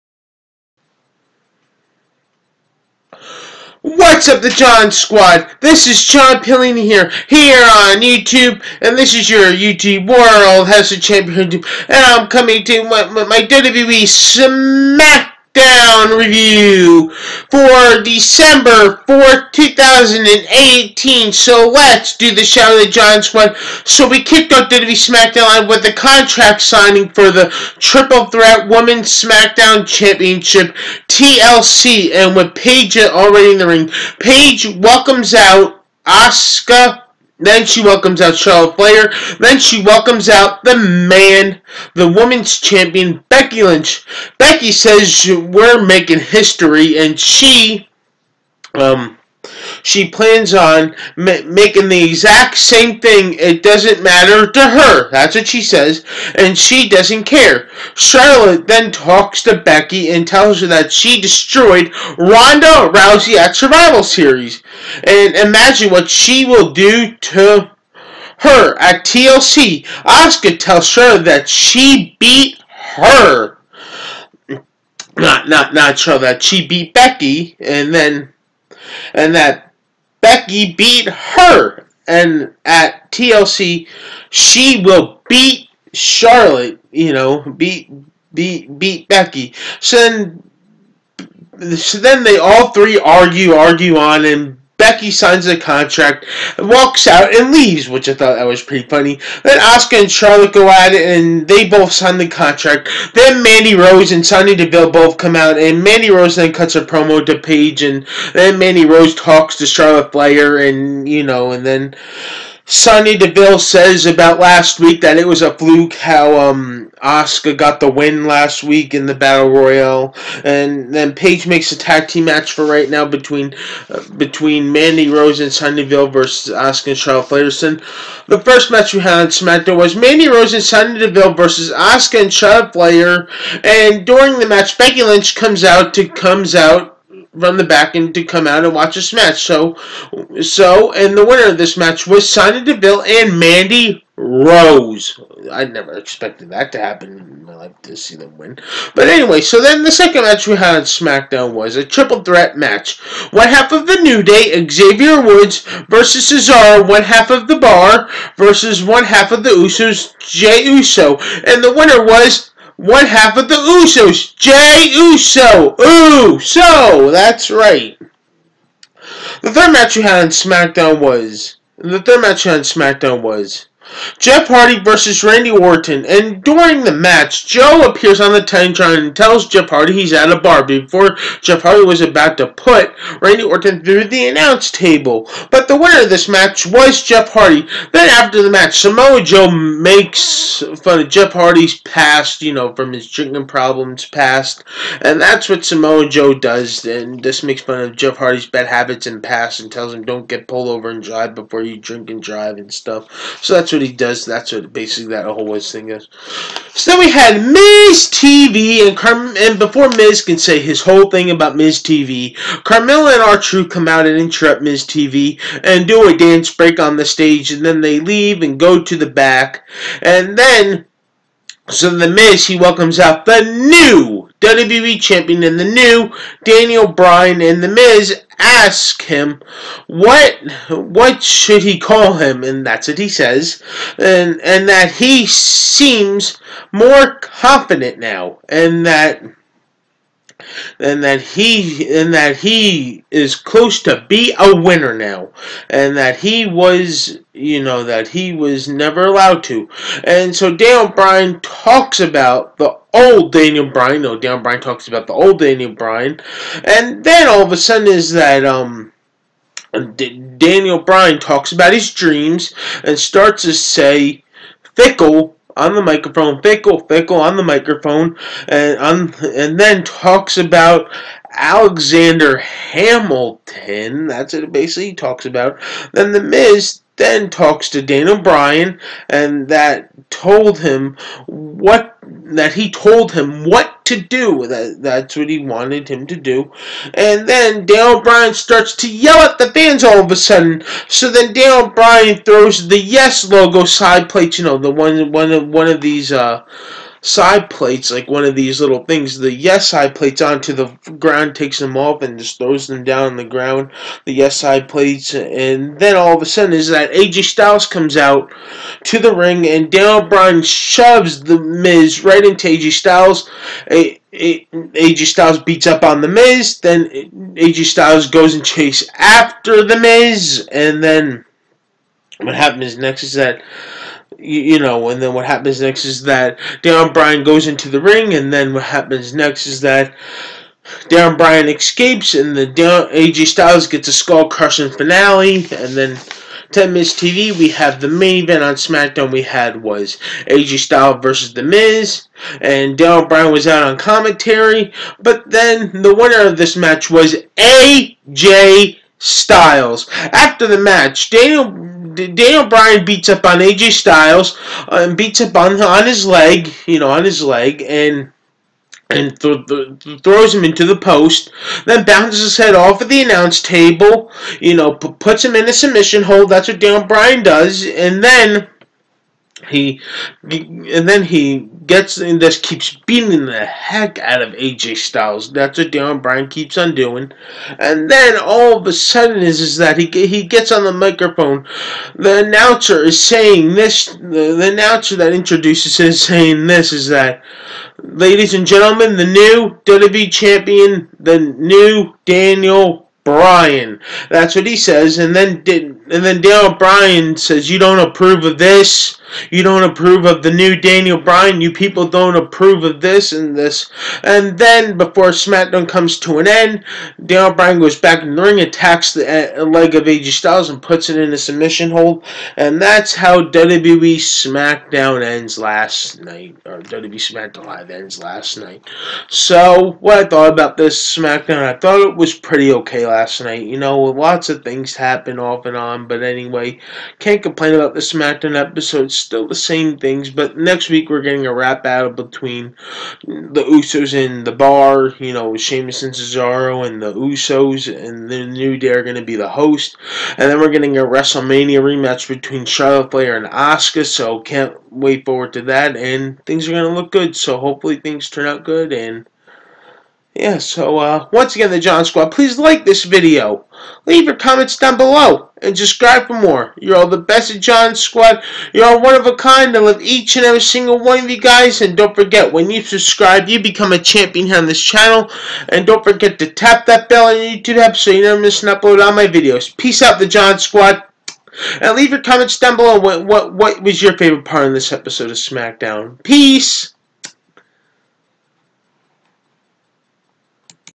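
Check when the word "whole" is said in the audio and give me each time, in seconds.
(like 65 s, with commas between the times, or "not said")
205 s, 210 s.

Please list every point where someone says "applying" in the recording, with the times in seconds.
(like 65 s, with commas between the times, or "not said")
not said.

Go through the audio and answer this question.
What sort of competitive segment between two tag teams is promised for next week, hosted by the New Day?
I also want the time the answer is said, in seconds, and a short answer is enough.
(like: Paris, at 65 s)
Rap battle, at 431 s.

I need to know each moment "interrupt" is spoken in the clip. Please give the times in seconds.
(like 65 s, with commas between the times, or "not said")
214 s.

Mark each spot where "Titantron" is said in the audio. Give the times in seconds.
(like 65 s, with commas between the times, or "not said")
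178 s.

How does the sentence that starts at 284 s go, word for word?
That, that's what he wanted him to do.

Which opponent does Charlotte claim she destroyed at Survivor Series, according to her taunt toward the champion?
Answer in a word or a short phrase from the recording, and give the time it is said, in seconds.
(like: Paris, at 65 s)
Ronda Rousey, at 62 s.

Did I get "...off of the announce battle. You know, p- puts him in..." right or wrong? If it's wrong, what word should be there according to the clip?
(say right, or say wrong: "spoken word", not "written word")
wrong: "table", not "battle".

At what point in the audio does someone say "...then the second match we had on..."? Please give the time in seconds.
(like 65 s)
149 s.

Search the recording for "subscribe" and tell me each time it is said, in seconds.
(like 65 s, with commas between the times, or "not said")
455 s, 462 s.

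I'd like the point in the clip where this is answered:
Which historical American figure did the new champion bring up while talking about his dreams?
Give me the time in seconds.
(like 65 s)
271 s.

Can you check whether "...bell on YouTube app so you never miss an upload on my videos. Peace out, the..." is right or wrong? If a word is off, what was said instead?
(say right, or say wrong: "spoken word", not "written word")
right.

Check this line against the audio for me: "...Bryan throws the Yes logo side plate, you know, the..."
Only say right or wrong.
right.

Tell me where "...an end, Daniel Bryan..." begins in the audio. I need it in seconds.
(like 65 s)
406 s.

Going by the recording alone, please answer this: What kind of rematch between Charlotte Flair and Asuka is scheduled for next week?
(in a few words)
WrestleMania rematch.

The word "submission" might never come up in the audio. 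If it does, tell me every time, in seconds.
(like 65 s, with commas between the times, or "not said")
365 s, 411 s.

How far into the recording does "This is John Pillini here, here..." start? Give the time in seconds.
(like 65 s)
5 s.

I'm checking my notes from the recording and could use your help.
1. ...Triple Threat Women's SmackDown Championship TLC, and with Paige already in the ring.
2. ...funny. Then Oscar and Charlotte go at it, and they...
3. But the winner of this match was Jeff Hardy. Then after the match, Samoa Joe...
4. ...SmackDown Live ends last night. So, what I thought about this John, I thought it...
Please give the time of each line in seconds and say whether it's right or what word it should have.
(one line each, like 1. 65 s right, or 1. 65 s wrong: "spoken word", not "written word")
1. 27 s right
2. 98 s right
3. 185 s right
4. 416 s wrong: "SmackDown", not "John".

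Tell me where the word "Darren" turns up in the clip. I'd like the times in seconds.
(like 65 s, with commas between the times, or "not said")
332 s.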